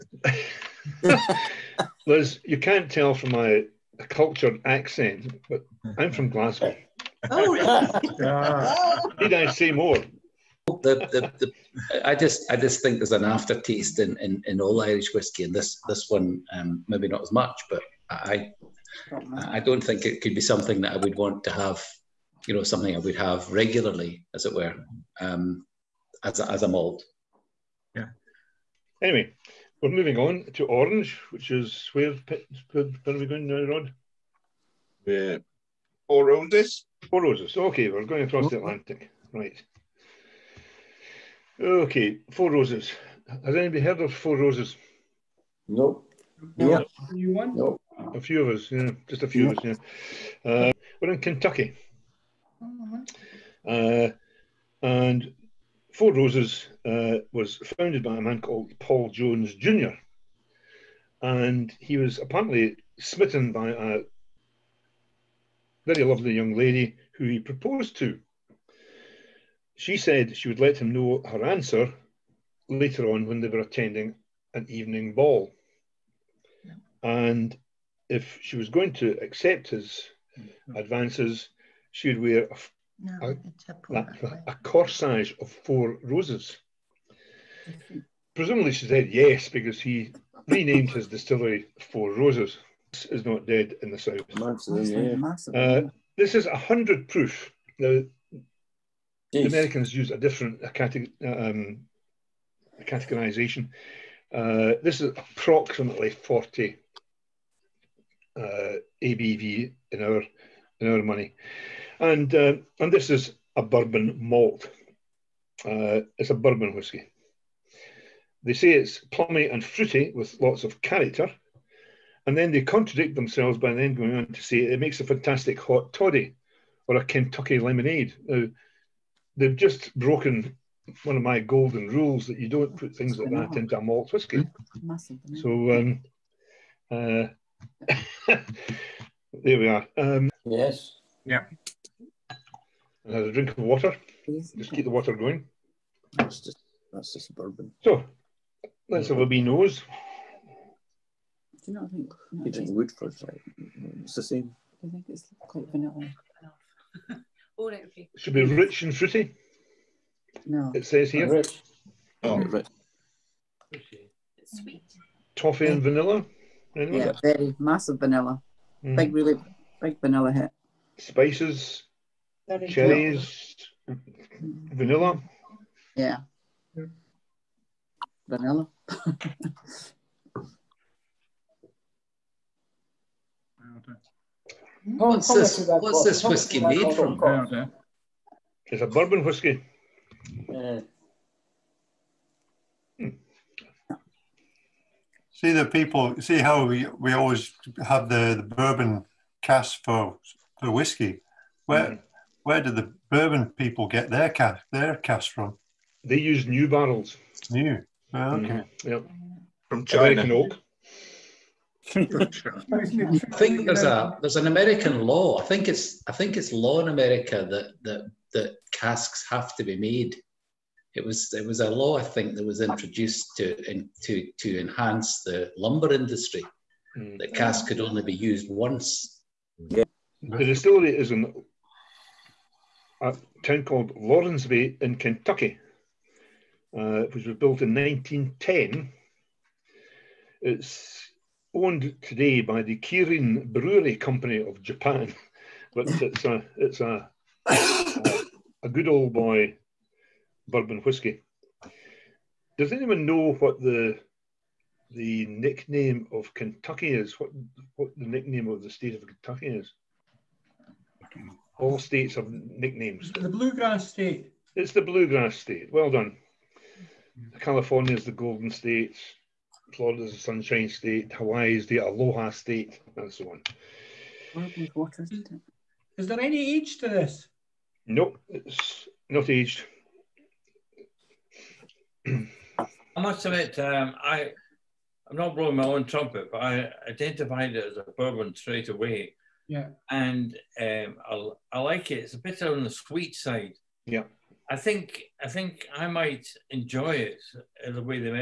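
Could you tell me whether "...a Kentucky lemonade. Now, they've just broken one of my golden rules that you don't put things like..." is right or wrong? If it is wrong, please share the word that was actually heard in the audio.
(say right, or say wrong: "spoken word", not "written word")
right.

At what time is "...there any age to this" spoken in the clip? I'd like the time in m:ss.
4:36.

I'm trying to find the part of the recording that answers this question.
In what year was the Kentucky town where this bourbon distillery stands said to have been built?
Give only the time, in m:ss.
3:57.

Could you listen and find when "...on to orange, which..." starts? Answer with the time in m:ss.
0:30.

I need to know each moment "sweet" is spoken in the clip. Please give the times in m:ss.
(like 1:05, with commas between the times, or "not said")
2:44, 4:52.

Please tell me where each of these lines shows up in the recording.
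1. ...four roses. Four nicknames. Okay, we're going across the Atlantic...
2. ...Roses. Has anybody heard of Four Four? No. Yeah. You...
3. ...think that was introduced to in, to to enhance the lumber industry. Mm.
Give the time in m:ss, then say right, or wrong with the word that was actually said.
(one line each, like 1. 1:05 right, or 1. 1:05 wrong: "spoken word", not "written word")
1. 0:36 wrong: "roses", not "nicknames"
2. 0:42 wrong: "Roses", not "Four"
3. 3:42 right.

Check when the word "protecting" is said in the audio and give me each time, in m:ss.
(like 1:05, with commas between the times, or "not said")
not said.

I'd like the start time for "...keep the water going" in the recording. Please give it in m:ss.
2:24.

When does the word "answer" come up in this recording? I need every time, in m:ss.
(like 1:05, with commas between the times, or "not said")
1:11.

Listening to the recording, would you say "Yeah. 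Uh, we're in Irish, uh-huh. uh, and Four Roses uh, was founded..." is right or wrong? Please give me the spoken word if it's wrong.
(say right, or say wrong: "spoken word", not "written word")
wrong: "Kentucky", not "Irish".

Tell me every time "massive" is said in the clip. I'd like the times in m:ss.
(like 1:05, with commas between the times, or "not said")
1:34, 2:47.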